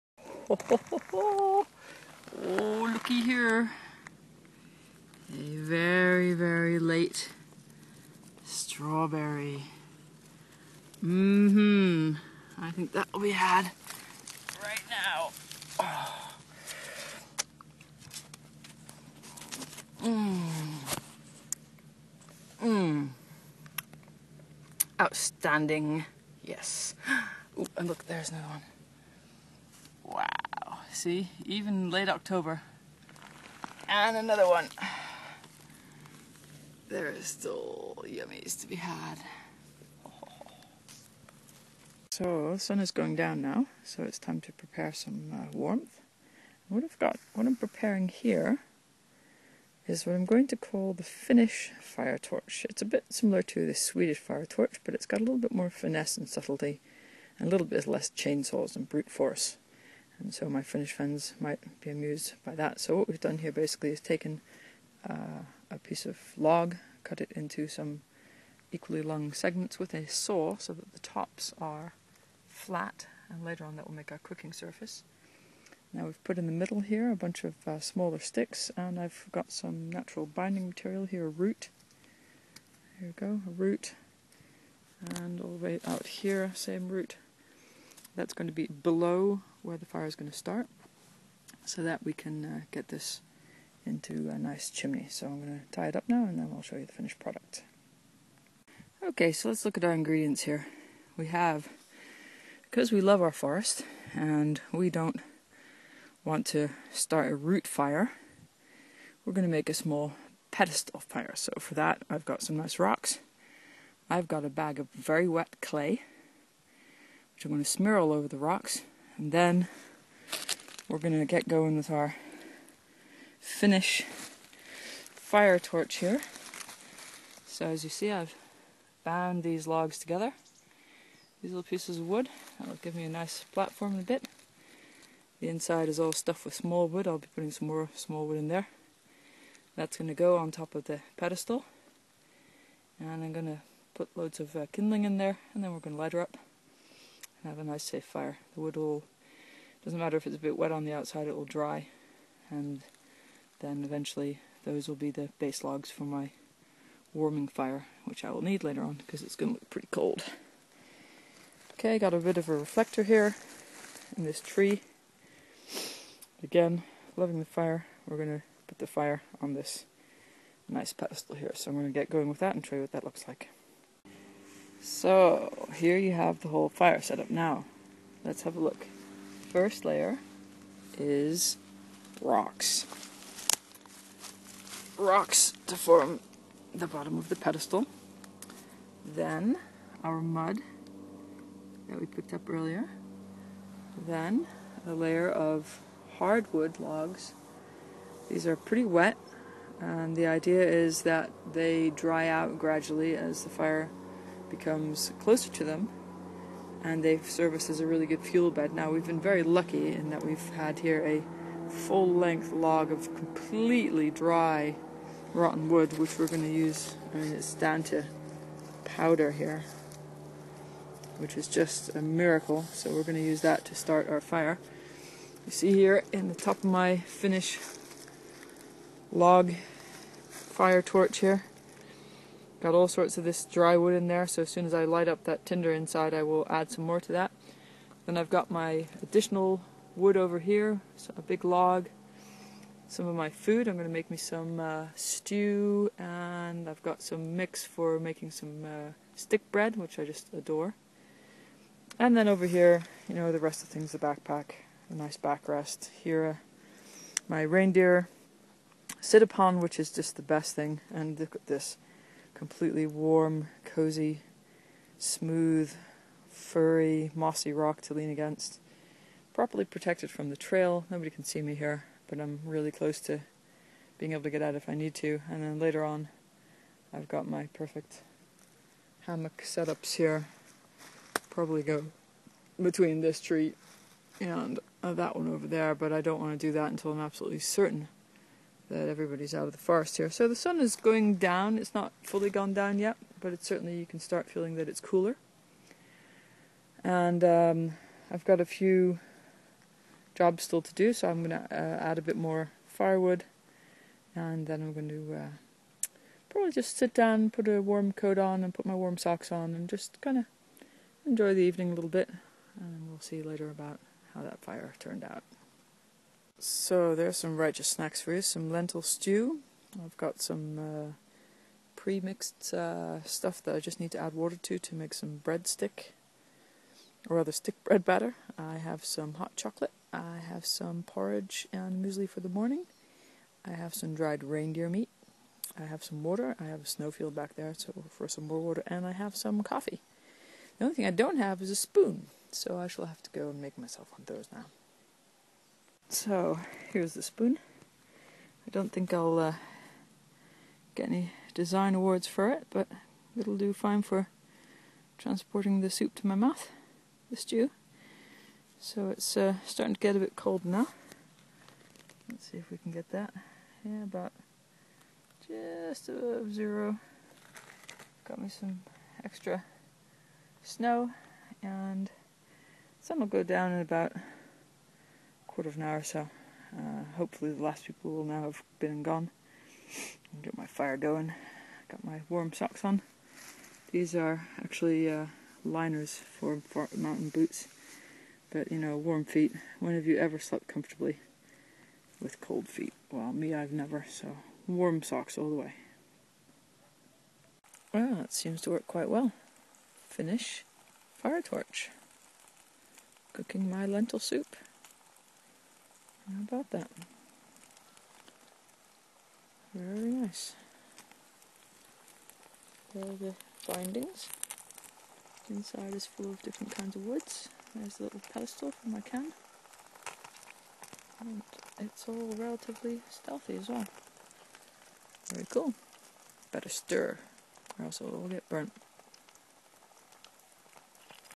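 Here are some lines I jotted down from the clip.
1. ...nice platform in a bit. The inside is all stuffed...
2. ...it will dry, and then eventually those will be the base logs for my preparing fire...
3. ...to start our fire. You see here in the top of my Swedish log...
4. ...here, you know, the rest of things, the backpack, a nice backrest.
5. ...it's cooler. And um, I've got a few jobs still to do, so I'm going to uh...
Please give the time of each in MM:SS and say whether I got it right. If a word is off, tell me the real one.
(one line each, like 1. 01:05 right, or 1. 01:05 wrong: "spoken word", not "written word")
1. 02:13 right
2. 02:31 wrong: "warming", not "preparing"
3. 03:43 wrong: "Finnish", not "Swedish"
4. 04:12 right
5. 04:54 right.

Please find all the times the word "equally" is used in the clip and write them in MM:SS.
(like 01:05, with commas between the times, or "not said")
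01:08.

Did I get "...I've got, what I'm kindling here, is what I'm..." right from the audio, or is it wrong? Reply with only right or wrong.
wrong.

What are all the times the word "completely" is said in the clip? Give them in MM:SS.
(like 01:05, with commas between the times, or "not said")
03:33, 04:22.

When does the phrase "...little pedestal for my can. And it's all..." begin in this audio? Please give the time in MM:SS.
06:57.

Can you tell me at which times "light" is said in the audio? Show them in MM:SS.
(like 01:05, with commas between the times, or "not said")
02:26, 03:54.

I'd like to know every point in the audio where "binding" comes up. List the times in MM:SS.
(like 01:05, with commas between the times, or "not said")
01:20, 06:53.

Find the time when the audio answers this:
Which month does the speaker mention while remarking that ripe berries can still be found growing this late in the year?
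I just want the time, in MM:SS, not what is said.
00:31.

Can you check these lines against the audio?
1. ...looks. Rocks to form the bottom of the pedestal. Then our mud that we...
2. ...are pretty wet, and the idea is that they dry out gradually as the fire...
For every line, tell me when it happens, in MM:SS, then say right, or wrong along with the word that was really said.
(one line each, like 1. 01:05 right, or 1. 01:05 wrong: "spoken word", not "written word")
1. 03:02 wrong: "rocks", not "looks"
2. 03:18 right.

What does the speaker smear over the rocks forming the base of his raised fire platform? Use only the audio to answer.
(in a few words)
Wet clay.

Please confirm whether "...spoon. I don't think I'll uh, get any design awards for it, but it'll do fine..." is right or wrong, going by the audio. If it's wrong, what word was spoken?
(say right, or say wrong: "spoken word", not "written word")
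right.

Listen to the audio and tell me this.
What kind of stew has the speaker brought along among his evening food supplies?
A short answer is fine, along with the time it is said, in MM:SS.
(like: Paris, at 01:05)
Lentil stew, at 05:18.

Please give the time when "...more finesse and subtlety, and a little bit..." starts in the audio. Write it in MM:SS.
00:55.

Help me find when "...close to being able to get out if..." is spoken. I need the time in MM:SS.
04:32.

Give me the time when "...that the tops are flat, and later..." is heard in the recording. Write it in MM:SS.
01:10.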